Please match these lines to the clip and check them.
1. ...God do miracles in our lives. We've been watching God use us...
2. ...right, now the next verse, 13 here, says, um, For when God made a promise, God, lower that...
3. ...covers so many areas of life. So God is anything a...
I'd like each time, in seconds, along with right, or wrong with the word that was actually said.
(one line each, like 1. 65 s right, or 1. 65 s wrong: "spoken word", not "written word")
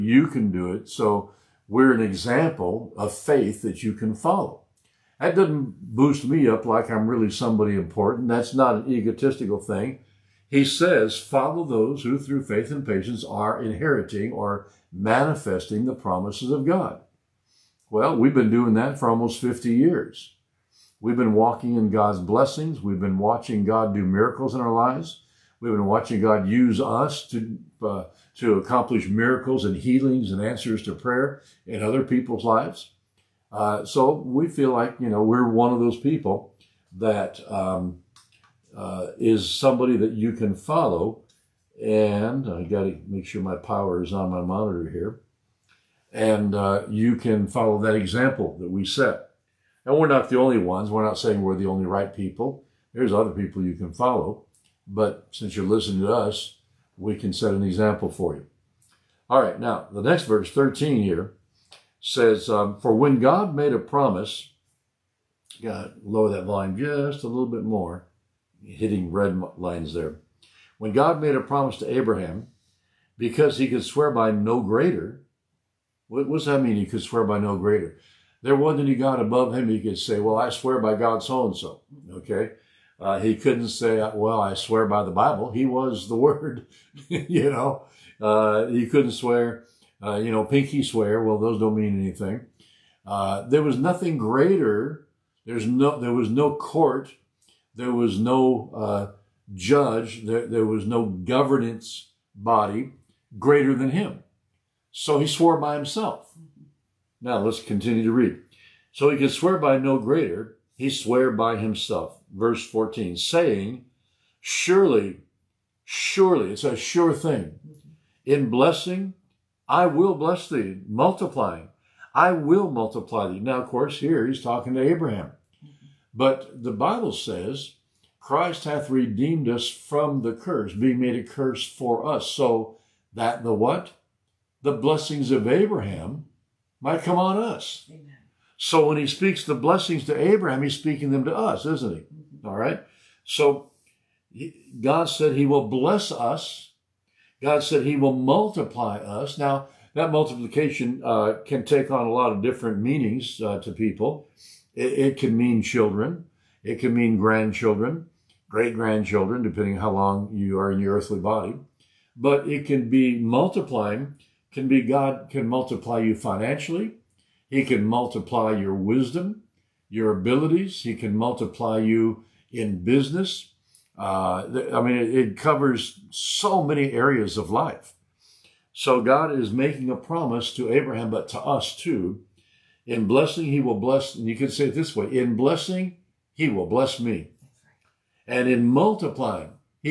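1. 23 s right
2. 59 s right
3. 175 s wrong: "making", not "anything".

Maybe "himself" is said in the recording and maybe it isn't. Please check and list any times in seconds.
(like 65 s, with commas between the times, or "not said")
105 s, 111 s.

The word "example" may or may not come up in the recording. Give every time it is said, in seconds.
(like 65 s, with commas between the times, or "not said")
2 s, 47 s, 57 s.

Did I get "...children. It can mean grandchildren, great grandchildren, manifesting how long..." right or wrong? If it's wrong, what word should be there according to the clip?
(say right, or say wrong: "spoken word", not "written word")
wrong: "depending", not "manifesting".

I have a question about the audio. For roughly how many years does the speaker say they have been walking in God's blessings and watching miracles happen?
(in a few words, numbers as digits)
almost 50 years.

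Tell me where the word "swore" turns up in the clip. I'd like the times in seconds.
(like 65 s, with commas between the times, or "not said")
105 s, 110 s.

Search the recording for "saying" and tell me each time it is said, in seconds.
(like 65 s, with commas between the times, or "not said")
51 s, 113 s.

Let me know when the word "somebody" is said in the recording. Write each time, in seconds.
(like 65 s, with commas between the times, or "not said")
7 s, 39 s.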